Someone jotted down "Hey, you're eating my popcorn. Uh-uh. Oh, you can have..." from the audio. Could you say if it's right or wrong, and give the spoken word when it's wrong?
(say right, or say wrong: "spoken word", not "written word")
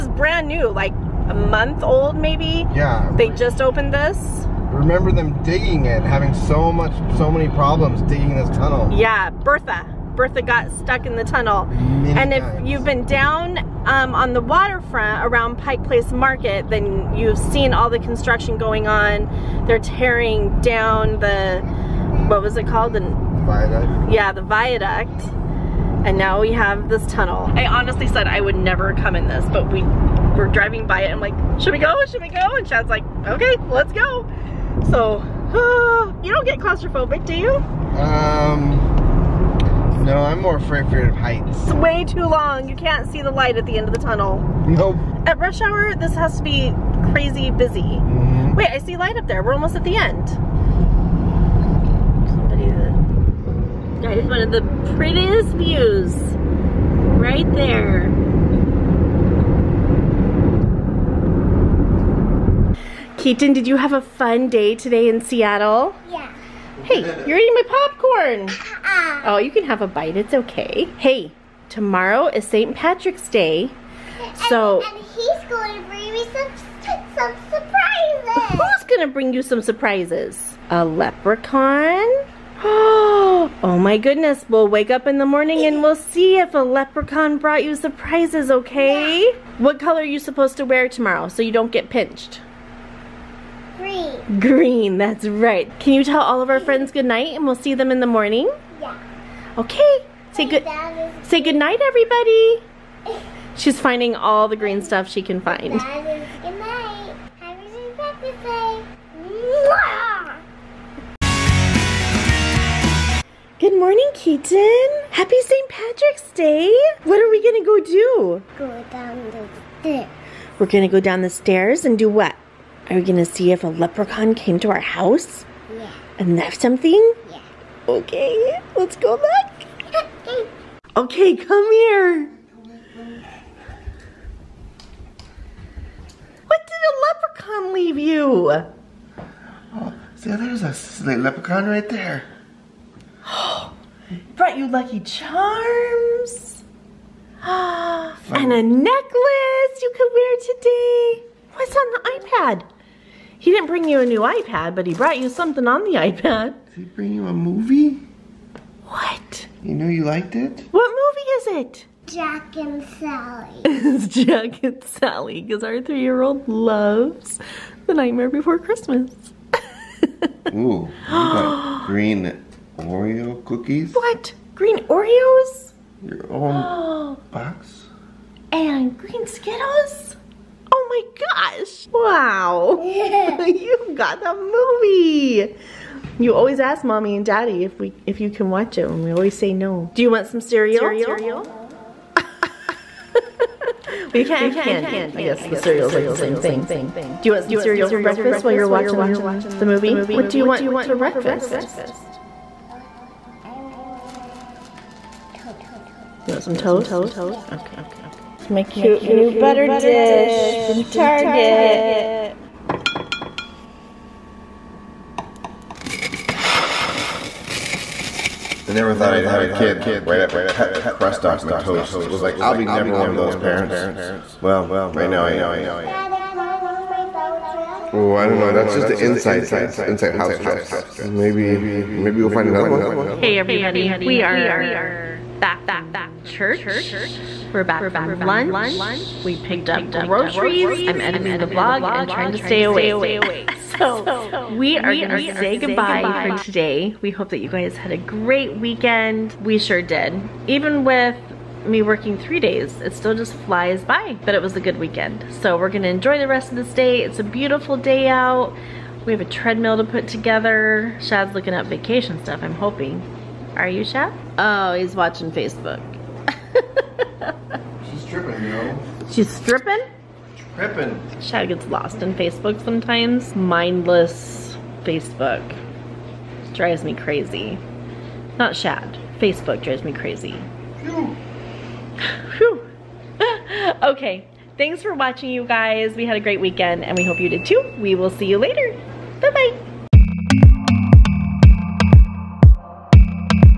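right.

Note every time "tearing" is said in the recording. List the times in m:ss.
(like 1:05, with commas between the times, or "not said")
0:19.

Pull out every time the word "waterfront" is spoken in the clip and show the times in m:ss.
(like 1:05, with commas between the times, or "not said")
0:14.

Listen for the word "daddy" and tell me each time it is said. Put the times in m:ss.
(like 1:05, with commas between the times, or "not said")
3:07, 3:45.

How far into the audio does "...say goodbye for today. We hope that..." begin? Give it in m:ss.
4:05.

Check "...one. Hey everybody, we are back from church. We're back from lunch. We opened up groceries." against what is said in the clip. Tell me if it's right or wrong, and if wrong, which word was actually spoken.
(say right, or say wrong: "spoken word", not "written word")
wrong: "picked", not "opened".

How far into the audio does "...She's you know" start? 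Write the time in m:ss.
4:27.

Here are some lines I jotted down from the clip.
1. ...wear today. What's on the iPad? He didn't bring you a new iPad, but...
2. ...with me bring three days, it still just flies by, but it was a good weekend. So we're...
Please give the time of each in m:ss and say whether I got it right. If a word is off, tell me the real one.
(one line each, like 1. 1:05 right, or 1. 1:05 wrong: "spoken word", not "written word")
1. 2:30 right
2. 4:10 wrong: "working", not "bring".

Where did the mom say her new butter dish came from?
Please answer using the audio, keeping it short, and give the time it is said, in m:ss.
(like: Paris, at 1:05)
Target, at 3:30.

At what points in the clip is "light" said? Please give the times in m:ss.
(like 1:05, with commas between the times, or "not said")
0:43, 0:49.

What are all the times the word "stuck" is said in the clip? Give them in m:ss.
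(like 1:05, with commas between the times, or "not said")
0:10.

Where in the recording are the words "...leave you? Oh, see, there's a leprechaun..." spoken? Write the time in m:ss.
2:17.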